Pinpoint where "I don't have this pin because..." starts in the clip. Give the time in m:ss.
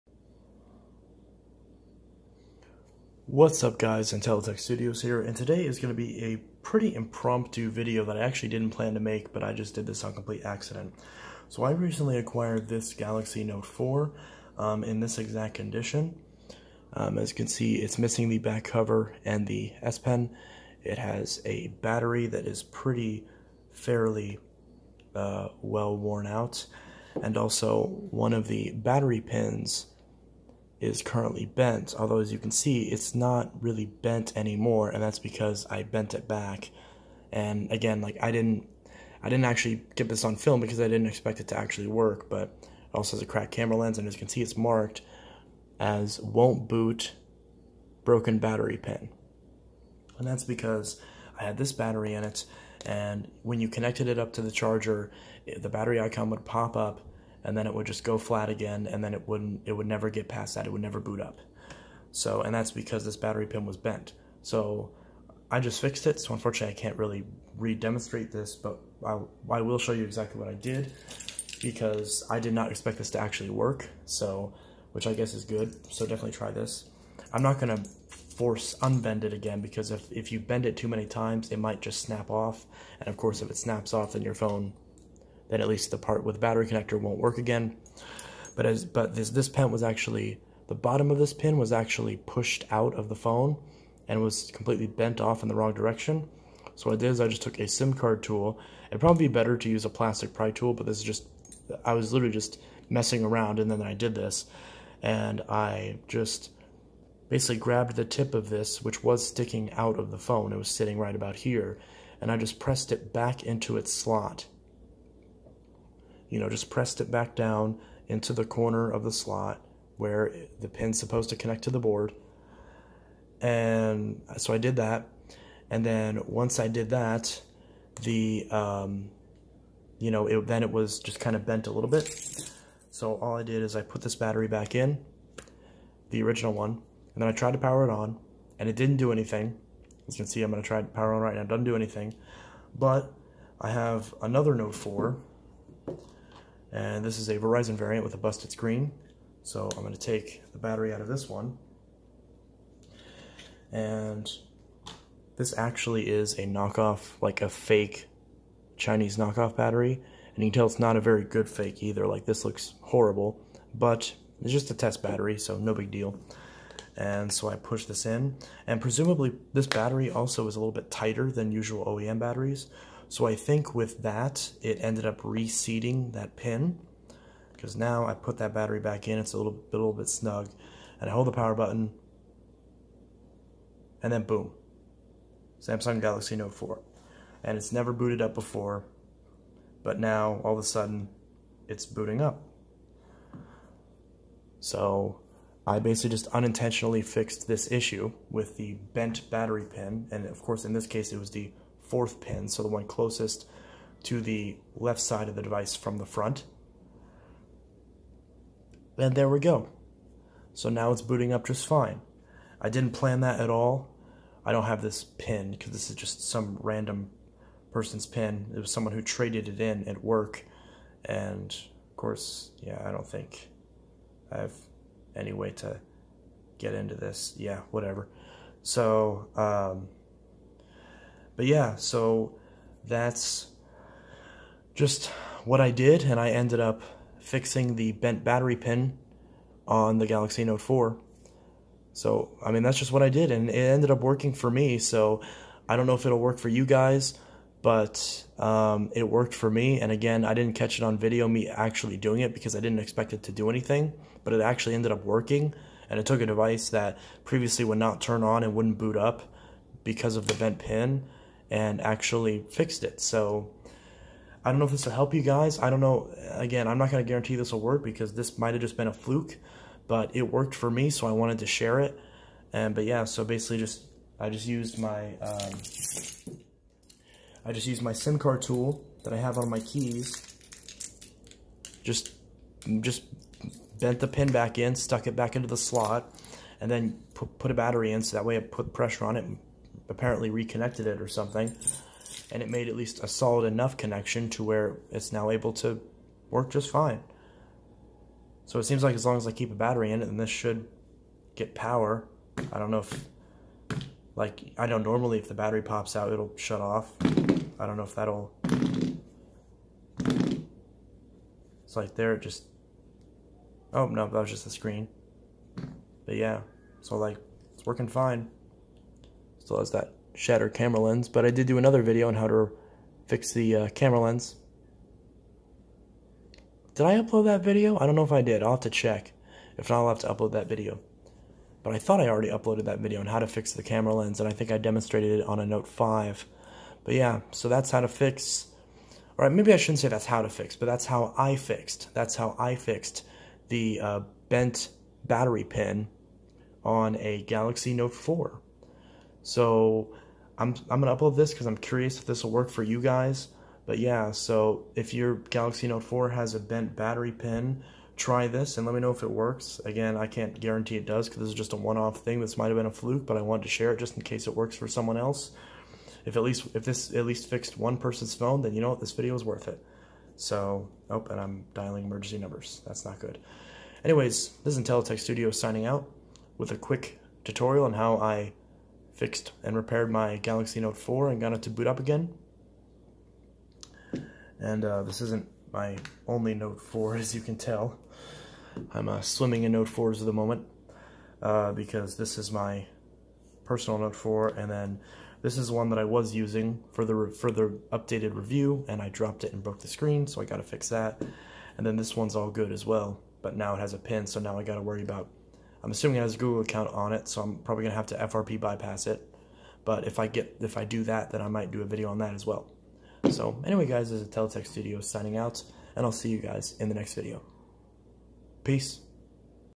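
3:34.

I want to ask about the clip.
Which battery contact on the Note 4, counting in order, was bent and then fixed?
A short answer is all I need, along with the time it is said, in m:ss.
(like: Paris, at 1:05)
fourth, at 3:21.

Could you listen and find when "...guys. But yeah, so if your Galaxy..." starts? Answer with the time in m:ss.
5:52.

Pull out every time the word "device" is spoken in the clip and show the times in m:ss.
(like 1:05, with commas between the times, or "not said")
3:25, 4:16.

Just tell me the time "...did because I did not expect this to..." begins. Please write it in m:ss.
1:10.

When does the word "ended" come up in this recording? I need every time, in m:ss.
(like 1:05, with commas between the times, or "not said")
2:54, 3:56, 4:03, 4:14.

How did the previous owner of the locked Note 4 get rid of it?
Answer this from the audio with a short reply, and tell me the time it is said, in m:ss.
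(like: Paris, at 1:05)
traded it in at work, at 3:39.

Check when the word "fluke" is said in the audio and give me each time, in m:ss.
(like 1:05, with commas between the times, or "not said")
4:28, 6:02.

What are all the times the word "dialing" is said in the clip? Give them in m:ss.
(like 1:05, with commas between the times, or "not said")
6:11.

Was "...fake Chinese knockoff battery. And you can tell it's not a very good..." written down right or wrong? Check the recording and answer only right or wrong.
right.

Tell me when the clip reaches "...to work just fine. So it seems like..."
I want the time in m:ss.
4:55.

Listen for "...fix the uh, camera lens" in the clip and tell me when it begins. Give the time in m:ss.
5:23.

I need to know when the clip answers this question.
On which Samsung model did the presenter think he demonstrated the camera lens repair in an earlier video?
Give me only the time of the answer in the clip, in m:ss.
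5:35.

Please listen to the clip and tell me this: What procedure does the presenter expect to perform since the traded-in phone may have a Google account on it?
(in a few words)
FRP bypass.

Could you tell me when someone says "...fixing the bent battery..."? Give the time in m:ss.
3:57.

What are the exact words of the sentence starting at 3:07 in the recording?
And it's never booted up before, but now all of a sudden it's booting up.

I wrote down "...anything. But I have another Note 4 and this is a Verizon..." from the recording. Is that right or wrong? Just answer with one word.
right.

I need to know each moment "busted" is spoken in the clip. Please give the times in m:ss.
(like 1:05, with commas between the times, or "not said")
2:28.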